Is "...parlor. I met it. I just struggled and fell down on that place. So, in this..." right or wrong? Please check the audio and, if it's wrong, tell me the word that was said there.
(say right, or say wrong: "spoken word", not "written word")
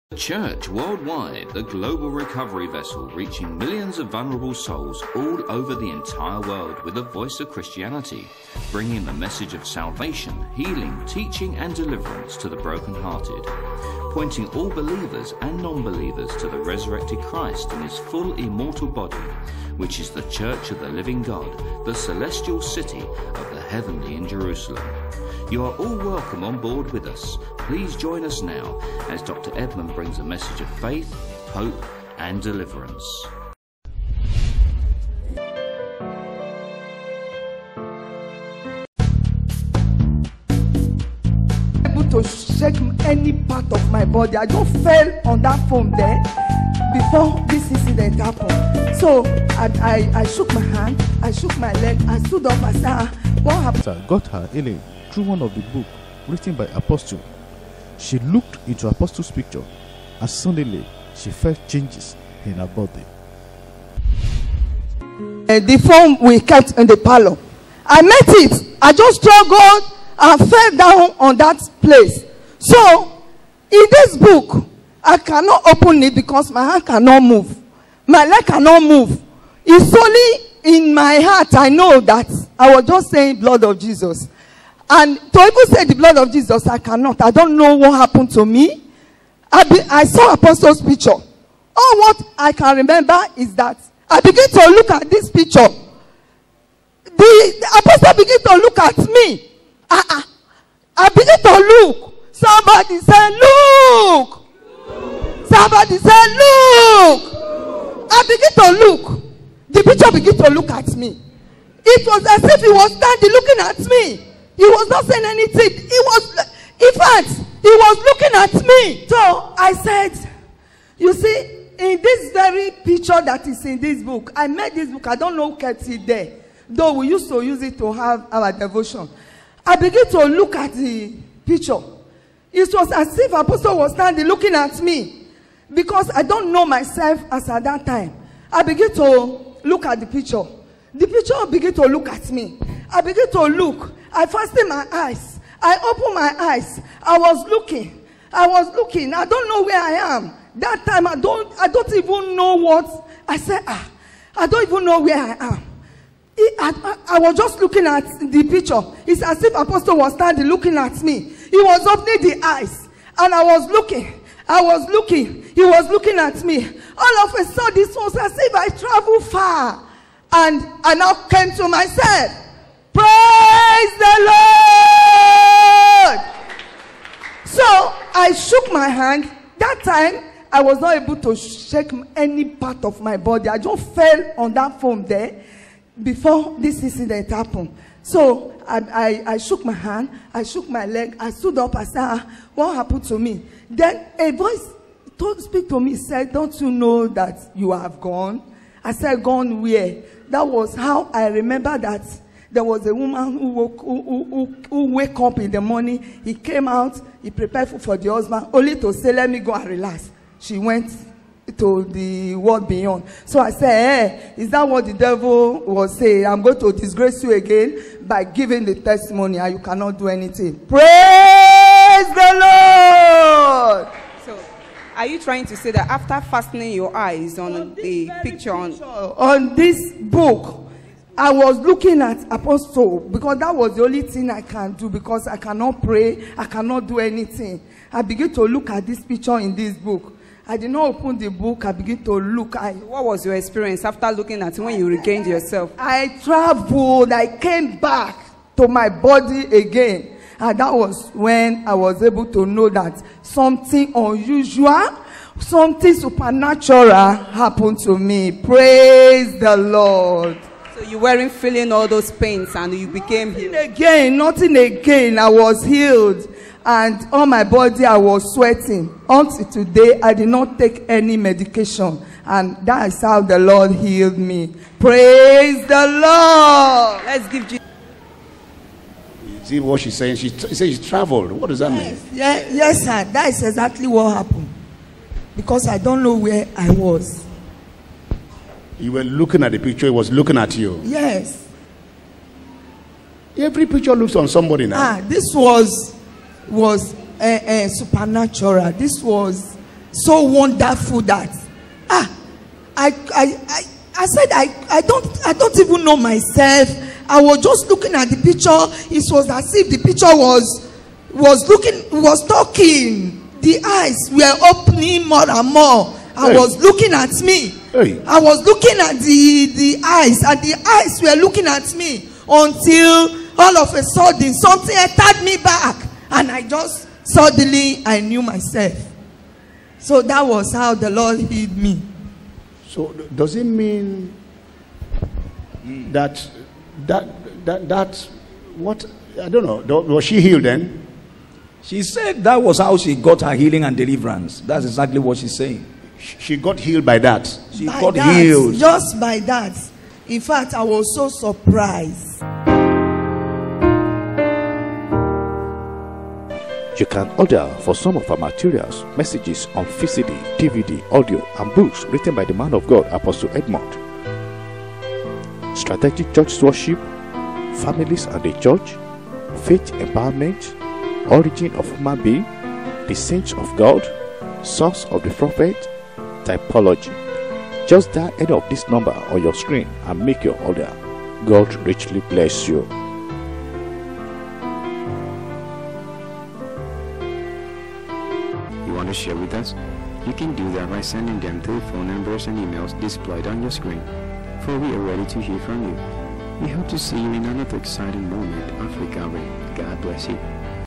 right.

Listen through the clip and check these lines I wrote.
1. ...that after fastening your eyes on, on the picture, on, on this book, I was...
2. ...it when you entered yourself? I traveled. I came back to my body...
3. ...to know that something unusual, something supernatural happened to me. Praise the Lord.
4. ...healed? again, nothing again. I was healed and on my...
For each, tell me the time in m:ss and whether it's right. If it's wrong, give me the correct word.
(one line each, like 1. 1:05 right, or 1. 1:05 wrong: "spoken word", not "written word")
1. 3:45 right
2. 4:04 wrong: "regained", not "entered"
3. 4:12 right
4. 4:23 right.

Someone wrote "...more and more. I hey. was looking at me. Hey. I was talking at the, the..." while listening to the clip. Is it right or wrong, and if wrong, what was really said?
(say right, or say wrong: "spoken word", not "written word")
wrong: "looking", not "talking".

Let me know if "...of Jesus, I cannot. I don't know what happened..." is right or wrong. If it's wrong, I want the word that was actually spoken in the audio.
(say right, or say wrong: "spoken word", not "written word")
right.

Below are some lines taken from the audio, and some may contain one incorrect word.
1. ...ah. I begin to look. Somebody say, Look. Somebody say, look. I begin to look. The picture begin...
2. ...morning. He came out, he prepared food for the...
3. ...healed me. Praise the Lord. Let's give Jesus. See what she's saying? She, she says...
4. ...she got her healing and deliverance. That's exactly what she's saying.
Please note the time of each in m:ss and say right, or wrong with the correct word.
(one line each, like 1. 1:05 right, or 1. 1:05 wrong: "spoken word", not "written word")
1. 1:40 right
2. 3:25 right
3. 4:33 right
4. 5:42 right.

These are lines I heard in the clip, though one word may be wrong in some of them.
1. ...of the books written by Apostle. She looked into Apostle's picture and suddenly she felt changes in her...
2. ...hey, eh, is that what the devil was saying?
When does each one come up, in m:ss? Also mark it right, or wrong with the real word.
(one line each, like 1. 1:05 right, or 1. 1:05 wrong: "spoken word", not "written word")
1. 0:55 right
2. 3:34 right.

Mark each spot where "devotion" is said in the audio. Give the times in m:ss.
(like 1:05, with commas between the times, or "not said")
2:08.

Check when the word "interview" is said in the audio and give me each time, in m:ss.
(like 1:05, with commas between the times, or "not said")
not said.